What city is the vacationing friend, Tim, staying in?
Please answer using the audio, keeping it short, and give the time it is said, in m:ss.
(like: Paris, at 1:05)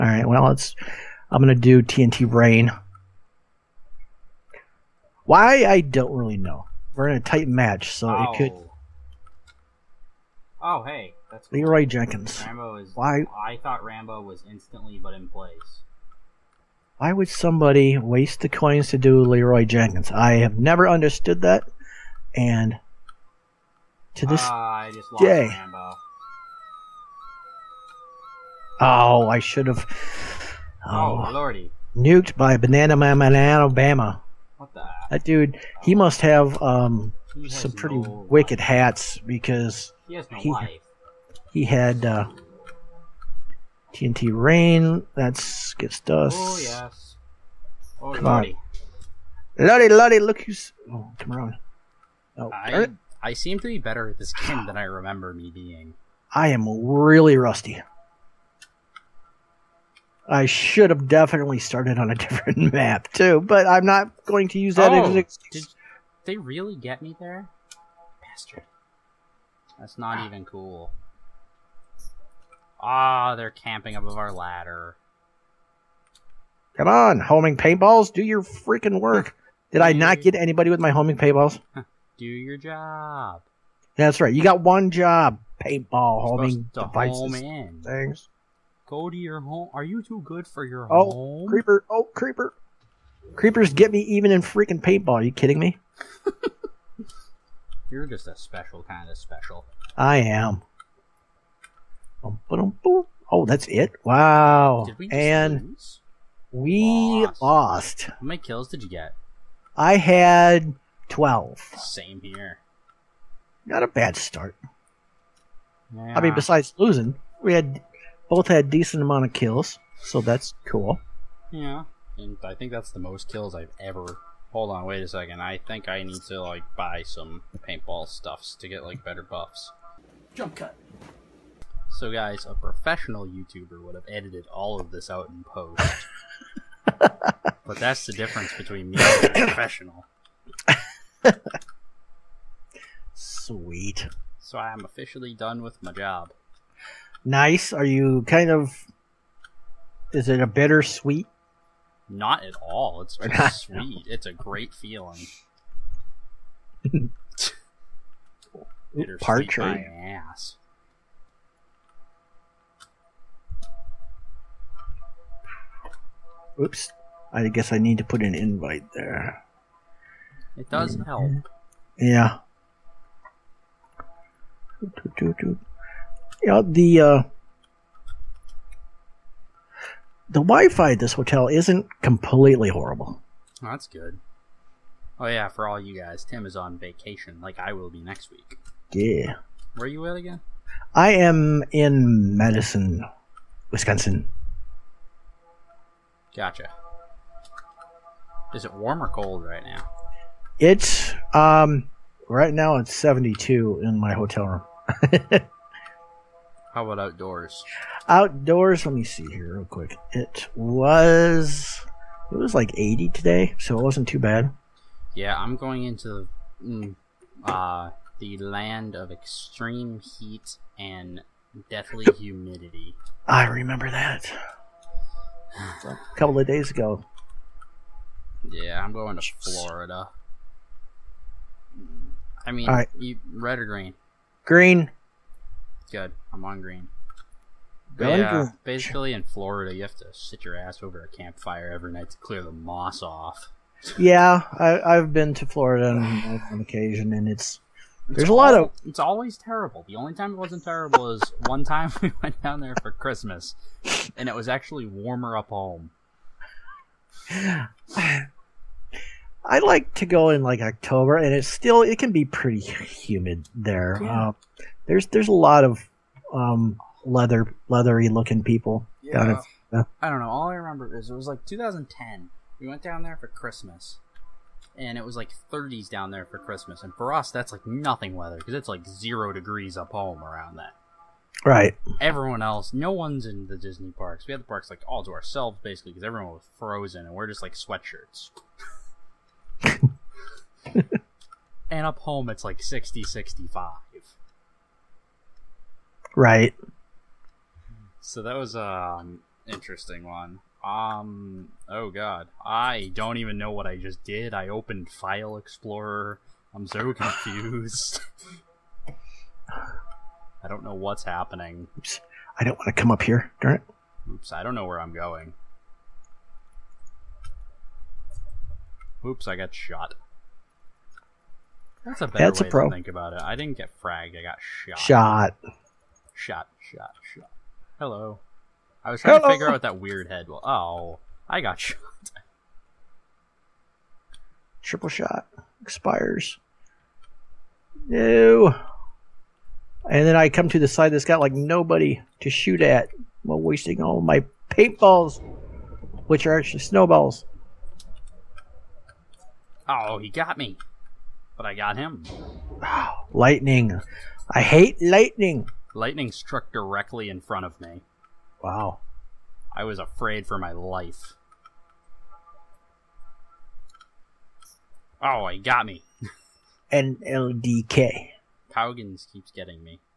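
Madison, Wisconsin, at 3:12.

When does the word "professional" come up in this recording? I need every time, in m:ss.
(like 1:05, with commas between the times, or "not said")
2:12, 2:19.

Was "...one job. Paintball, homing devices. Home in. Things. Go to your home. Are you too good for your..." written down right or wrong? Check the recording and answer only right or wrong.
right.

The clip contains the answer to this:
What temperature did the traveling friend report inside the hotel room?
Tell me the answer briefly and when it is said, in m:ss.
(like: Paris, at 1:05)
72, at 3:22.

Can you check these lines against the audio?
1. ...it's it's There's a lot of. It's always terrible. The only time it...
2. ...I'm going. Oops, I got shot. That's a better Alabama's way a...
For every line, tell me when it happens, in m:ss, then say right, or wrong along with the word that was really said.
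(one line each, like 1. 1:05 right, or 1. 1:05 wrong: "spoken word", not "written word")
1. 4:07 right
2. 5:14 wrong: "That", not "Alabama".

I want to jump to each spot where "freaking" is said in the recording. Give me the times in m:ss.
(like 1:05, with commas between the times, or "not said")
1:18, 1:34.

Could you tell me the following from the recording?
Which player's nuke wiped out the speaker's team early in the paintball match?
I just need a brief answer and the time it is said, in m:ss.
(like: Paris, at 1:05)
Banana Man in Alabama, at 0:32.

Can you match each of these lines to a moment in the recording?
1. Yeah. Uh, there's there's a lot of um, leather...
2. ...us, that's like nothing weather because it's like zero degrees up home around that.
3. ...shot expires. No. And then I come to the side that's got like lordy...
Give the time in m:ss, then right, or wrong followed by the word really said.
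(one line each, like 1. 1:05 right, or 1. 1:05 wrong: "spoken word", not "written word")
1. 4:24 right
2. 4:37 right
3. 5:34 wrong: "nobody", not "lordy".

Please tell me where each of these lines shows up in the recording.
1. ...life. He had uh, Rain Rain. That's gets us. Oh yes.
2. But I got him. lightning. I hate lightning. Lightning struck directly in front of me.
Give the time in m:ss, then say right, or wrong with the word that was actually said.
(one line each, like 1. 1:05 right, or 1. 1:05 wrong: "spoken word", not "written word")
1. 0:40 wrong: "TNT", not "Rain"
2. 5:51 right.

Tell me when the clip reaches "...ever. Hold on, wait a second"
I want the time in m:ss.
2:03.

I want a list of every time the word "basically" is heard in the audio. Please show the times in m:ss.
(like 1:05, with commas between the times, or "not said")
3:58, 4:45.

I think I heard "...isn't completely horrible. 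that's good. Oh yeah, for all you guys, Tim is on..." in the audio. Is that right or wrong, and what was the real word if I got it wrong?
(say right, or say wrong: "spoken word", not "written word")
right.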